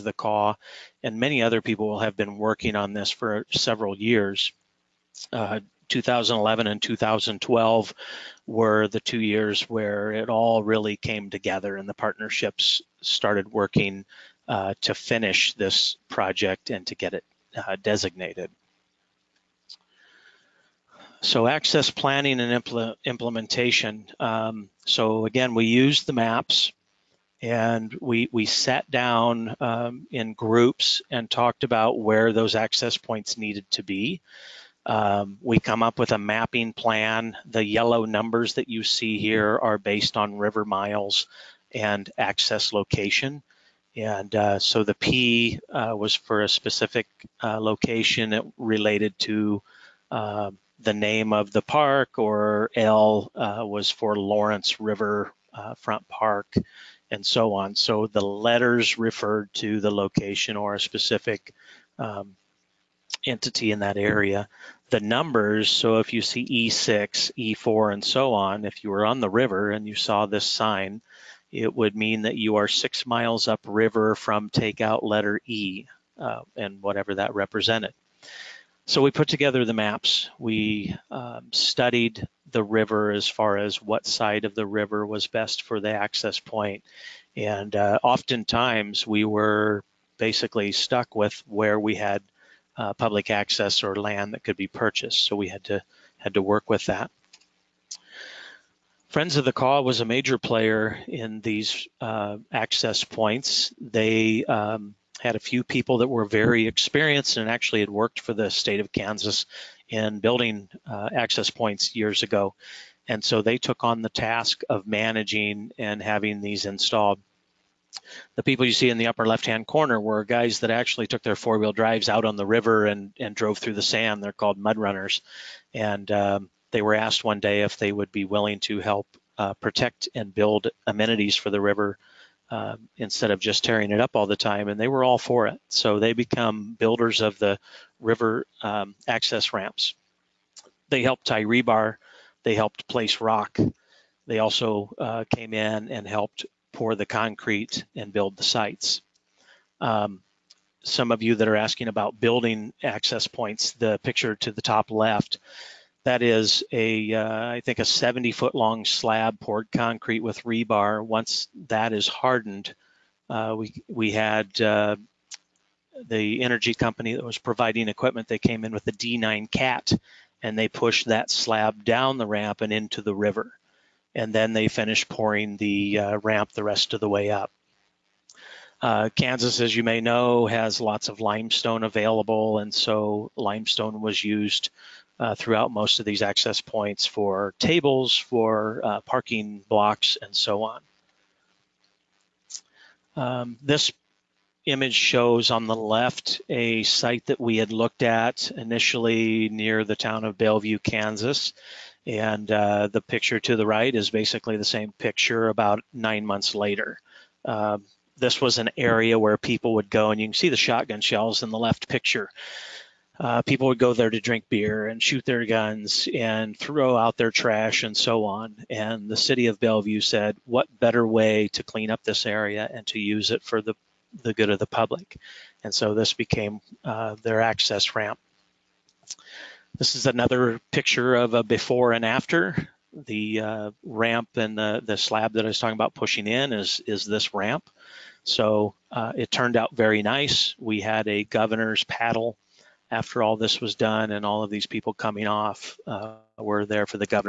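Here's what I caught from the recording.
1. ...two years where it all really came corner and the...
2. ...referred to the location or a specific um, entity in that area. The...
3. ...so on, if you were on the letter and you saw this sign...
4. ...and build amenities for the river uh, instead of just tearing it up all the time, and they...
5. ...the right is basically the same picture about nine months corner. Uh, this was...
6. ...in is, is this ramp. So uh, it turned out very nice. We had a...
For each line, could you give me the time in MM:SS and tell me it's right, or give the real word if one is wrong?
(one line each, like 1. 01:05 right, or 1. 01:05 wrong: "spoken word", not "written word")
1. 00:08 wrong: "together", not "corner"
2. 00:58 right
3. 01:08 wrong: "river", not "letter"
4. 02:10 right
5. 03:23 wrong: "later", not "corner"
6. 03:56 right.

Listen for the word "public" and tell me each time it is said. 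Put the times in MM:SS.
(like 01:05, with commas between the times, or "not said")
01:32, 03:44.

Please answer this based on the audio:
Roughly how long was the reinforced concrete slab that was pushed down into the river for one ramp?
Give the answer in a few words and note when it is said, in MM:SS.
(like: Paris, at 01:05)
70 feet, at 02:37.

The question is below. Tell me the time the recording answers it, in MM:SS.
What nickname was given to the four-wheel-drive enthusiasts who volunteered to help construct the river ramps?
02:04.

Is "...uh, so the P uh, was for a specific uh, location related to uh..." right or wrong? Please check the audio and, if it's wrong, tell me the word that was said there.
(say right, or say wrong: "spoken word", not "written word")
right.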